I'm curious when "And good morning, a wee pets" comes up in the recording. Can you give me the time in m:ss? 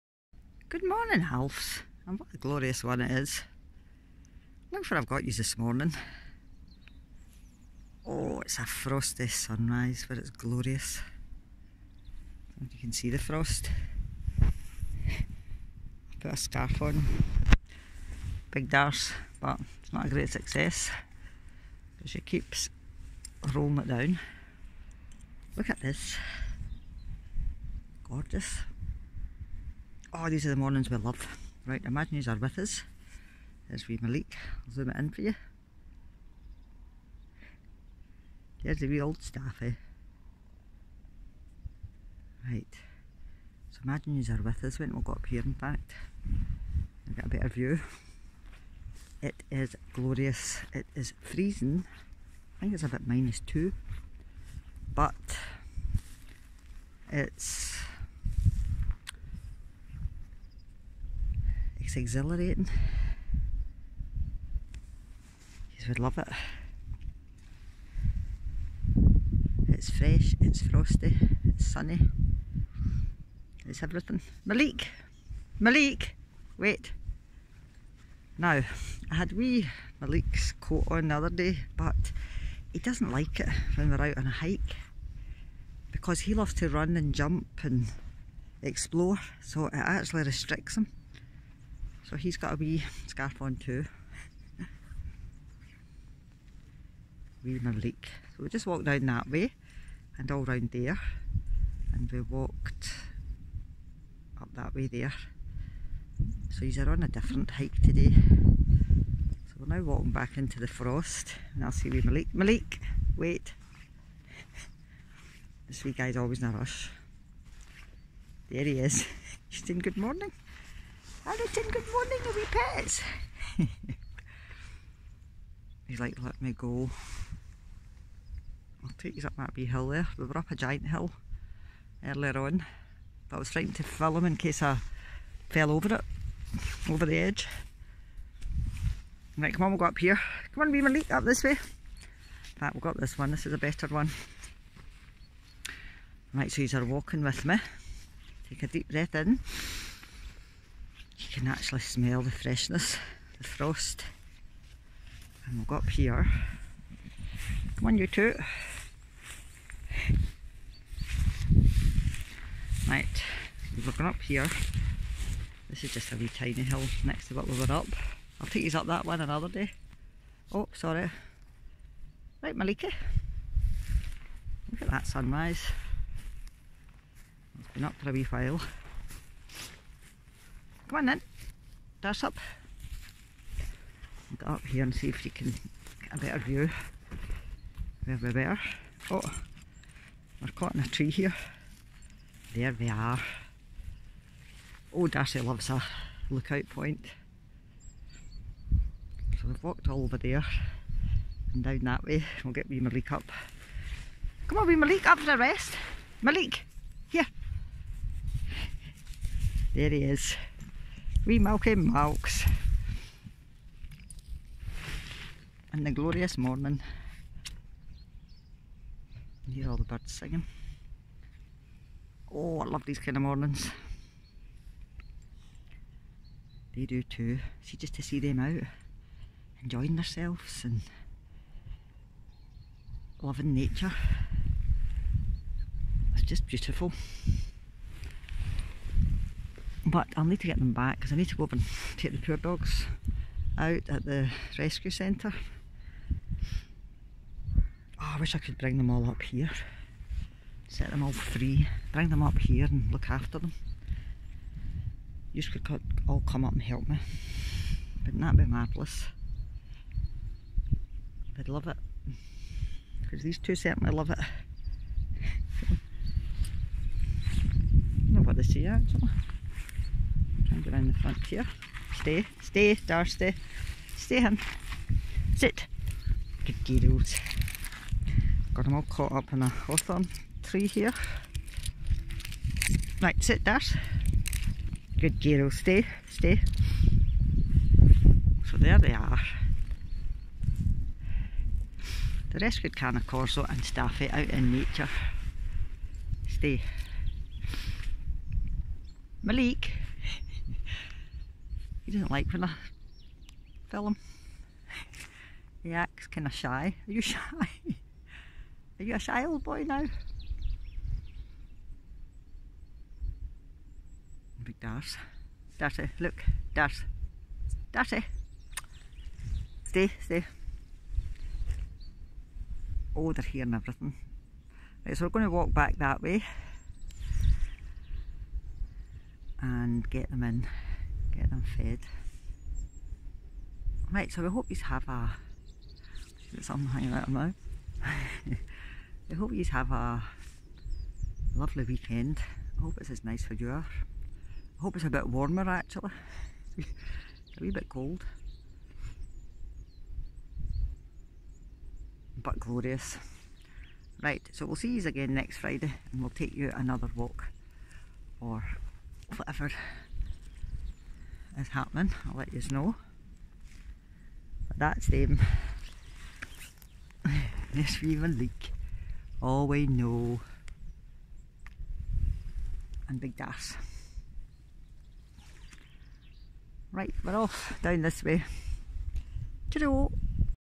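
2:01.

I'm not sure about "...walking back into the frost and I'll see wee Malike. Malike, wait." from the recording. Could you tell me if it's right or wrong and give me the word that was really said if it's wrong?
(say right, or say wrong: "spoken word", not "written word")
right.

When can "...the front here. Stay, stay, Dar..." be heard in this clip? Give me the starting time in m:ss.
4:30.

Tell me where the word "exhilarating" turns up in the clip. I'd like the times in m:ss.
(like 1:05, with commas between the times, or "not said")
1:01.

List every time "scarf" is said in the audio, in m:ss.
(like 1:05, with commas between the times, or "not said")
0:16, 1:33.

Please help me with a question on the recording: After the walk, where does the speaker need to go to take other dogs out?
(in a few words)
rescue centre.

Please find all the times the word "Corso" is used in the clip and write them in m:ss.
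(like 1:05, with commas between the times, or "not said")
4:53.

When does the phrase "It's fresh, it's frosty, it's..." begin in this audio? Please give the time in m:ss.
1:09.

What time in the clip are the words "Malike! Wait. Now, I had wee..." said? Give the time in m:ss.
1:15.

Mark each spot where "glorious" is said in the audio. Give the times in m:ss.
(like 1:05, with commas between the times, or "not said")
0:02, 0:10, 0:49, 3:35, 5:52.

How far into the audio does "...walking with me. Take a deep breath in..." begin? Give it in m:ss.
2:26.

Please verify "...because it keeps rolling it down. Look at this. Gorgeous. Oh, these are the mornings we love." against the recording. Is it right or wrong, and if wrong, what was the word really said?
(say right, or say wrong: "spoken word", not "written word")
right.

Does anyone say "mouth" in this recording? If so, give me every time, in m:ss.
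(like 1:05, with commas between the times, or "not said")
5:37.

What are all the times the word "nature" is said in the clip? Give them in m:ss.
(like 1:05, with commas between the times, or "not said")
3:53, 4:54.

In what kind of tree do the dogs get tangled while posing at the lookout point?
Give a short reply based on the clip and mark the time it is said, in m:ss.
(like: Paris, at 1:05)
hawthorn, at 4:39.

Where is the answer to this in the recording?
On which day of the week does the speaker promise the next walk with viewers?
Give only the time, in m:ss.
5:55.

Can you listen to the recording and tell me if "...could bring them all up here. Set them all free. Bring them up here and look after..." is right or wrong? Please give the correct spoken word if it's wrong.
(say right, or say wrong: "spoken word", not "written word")
right.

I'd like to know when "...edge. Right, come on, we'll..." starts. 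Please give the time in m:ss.
2:17.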